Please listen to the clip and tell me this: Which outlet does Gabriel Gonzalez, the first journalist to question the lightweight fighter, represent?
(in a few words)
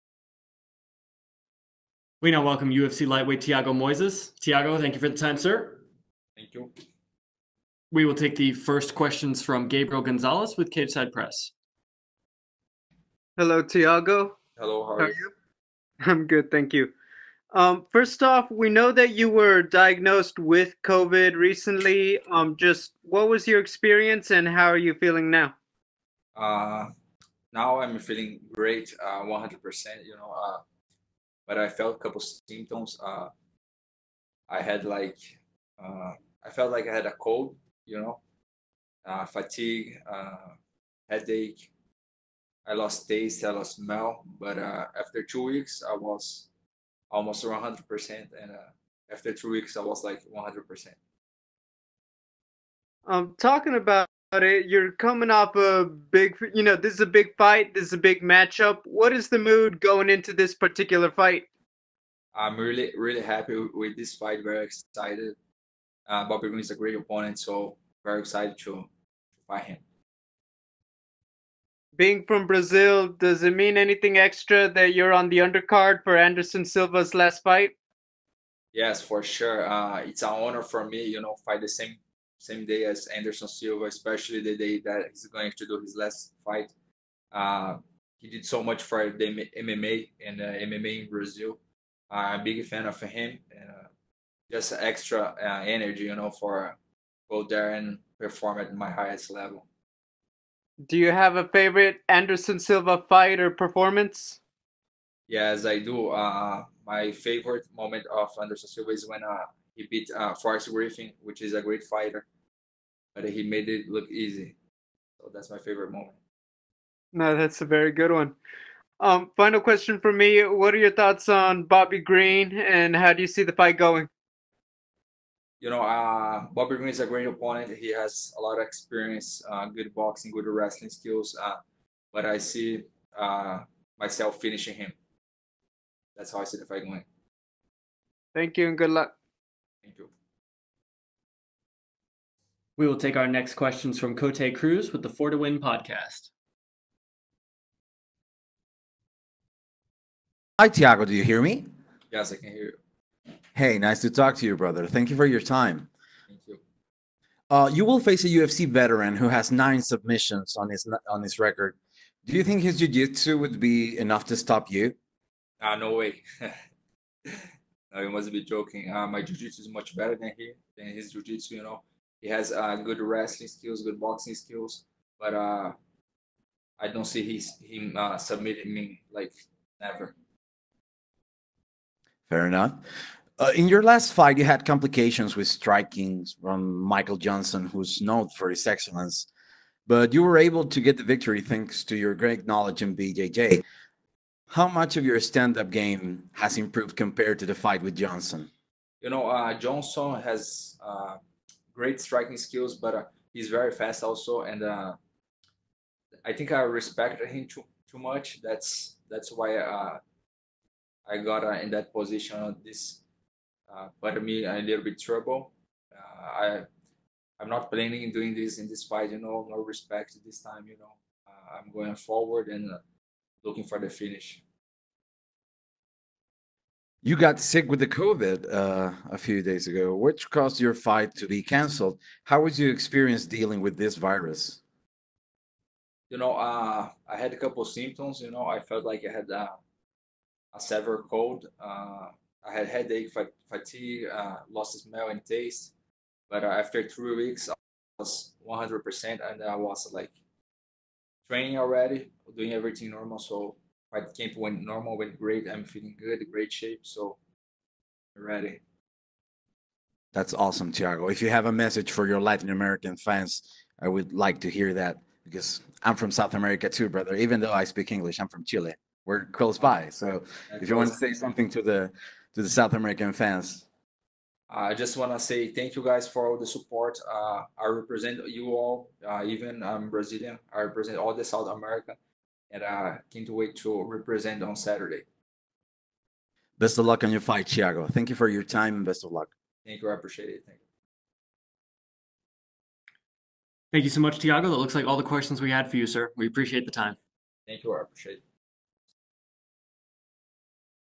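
Cageside Press.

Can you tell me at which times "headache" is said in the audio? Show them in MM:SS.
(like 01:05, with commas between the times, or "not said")
00:41, 04:02.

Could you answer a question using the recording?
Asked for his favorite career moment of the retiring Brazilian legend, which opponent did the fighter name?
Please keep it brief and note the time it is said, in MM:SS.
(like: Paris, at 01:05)
Forrest Griffin, at 01:50.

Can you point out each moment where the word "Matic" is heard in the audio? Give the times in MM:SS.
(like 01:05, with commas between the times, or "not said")
not said.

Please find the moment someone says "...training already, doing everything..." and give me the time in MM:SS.
04:11.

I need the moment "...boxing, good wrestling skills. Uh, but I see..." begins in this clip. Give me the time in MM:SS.
02:09.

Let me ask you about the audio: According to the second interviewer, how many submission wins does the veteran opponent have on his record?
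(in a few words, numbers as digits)
9.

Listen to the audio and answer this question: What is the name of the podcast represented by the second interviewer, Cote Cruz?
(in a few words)
Four to Win podcast.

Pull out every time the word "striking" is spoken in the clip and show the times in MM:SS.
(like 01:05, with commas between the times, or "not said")
03:05, 03:22.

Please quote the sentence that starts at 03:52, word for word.
How was your experience dealing with this virus?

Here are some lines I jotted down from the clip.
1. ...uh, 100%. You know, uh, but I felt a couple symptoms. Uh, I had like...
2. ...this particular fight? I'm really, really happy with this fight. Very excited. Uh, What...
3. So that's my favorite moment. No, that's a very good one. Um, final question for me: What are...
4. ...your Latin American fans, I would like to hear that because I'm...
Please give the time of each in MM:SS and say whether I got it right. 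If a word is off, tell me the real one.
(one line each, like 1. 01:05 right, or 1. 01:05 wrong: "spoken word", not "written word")
1. 00:29 right
2. 01:00 wrong: "Bobby", not "What"
3. 01:55 right
4. 04:22 right.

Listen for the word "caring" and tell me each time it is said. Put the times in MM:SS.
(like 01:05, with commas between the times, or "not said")
not said.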